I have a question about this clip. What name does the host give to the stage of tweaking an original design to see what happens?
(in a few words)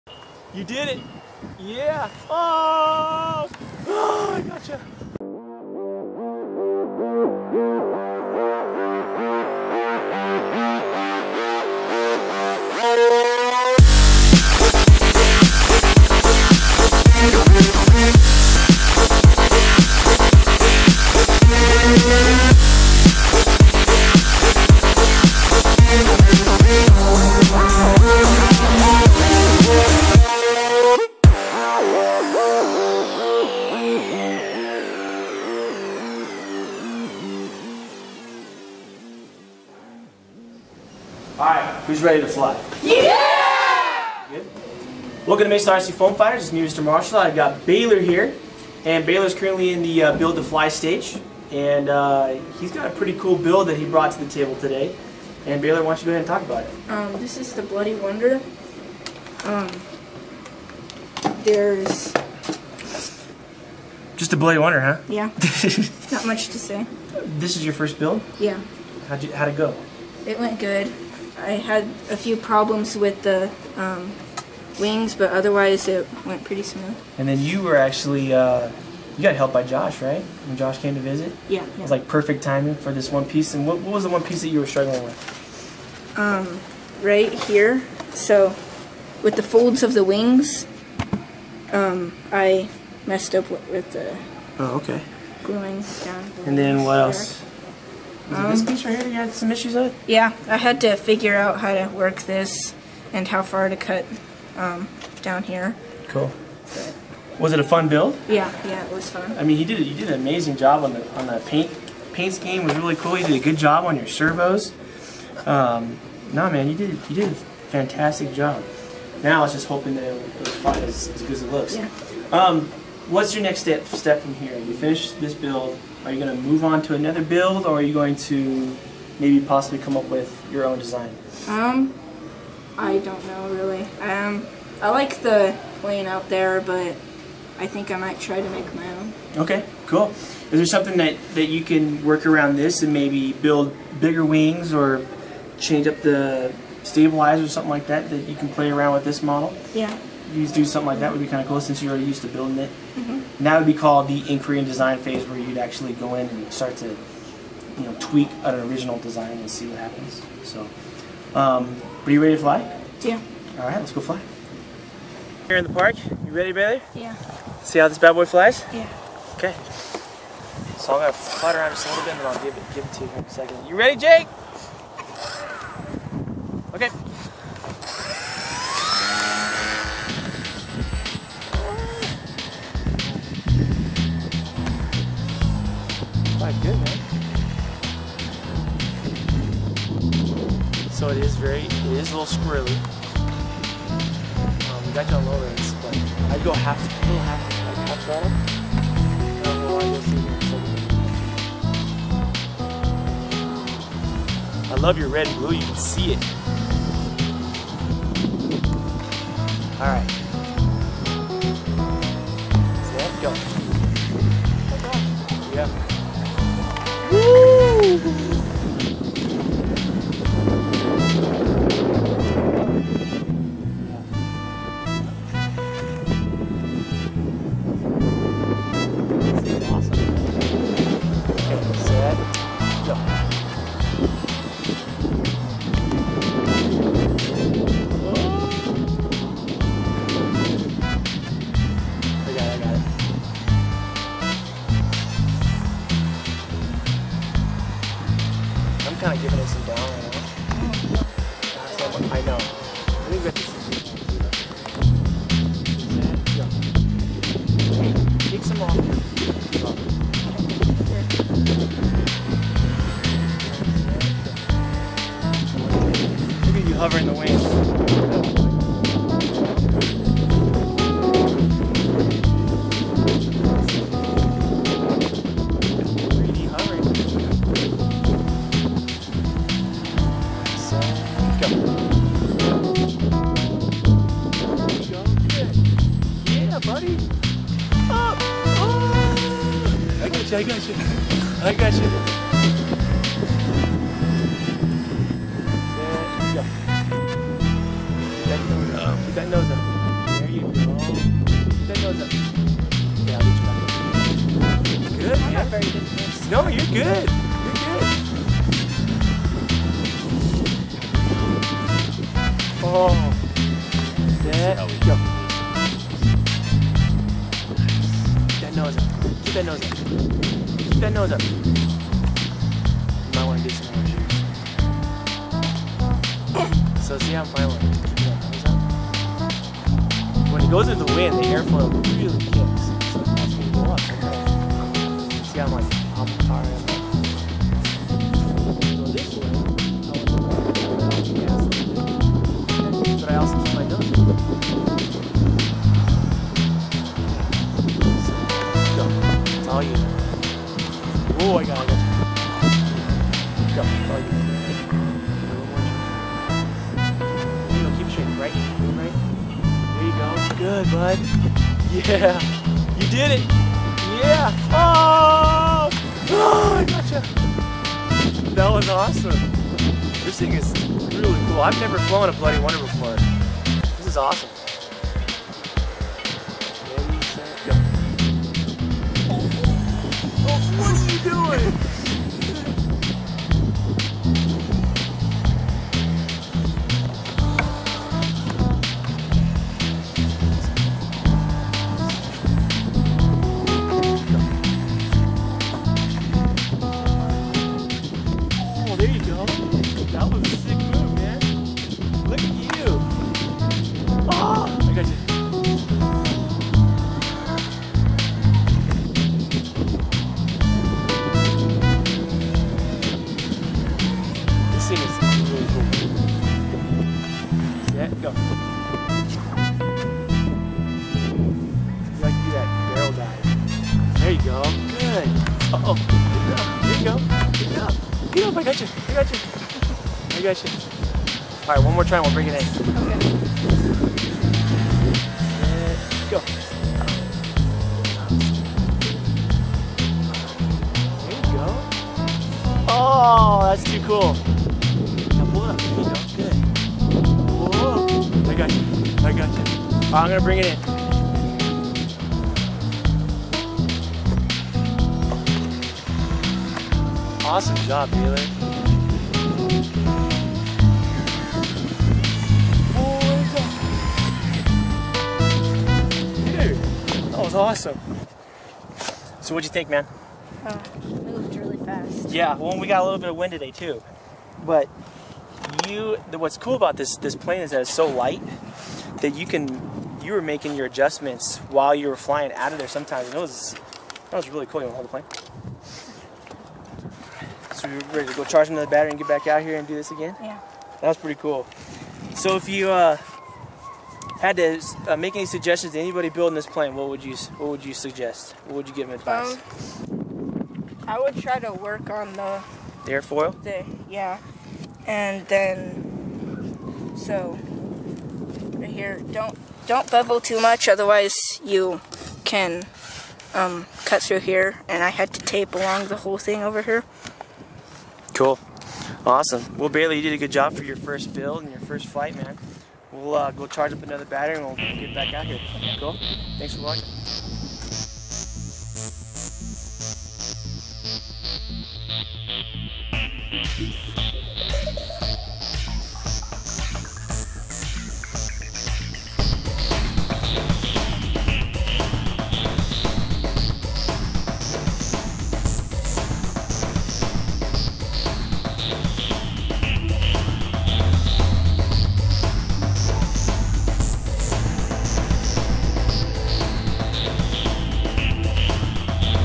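inquiry and design phase.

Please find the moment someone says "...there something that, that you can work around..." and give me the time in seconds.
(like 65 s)
140 s.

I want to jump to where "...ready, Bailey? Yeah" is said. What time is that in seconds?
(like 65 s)
166 s.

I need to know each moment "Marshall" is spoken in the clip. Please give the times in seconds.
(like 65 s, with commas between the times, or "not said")
46 s.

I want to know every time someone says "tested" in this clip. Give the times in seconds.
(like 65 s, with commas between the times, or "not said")
not said.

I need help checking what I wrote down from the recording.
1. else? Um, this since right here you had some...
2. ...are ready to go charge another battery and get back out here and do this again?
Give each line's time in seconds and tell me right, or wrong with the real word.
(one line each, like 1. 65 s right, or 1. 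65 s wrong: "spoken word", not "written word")
1. 97 s wrong: "piece", not "since"
2. 487 s right.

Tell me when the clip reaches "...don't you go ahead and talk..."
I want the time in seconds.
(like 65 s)
55 s.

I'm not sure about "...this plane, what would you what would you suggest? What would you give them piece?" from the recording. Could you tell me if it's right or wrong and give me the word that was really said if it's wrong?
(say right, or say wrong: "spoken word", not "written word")
wrong: "advice", not "piece".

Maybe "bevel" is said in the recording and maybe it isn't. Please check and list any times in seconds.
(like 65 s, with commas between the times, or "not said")
509 s.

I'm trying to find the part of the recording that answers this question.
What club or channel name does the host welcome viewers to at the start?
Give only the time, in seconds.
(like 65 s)
45 s.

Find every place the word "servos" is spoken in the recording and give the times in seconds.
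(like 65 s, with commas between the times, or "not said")
114 s.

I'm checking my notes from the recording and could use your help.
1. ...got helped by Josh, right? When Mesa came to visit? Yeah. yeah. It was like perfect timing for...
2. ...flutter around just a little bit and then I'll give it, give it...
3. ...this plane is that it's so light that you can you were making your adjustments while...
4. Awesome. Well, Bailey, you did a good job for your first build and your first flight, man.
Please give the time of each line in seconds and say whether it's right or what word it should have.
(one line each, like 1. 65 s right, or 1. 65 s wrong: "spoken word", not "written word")
1. 79 s wrong: "Josh", not "Mesa"
2. 171 s right
3. 476 s right
4. 519 s right.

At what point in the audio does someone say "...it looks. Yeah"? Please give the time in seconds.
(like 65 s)
121 s.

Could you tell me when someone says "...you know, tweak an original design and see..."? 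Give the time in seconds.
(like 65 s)
157 s.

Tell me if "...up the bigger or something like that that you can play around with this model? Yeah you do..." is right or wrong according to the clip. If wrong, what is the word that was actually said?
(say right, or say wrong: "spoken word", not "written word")
wrong: "stabilizer", not "bigger".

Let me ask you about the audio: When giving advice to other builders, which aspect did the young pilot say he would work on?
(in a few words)
the airfoil.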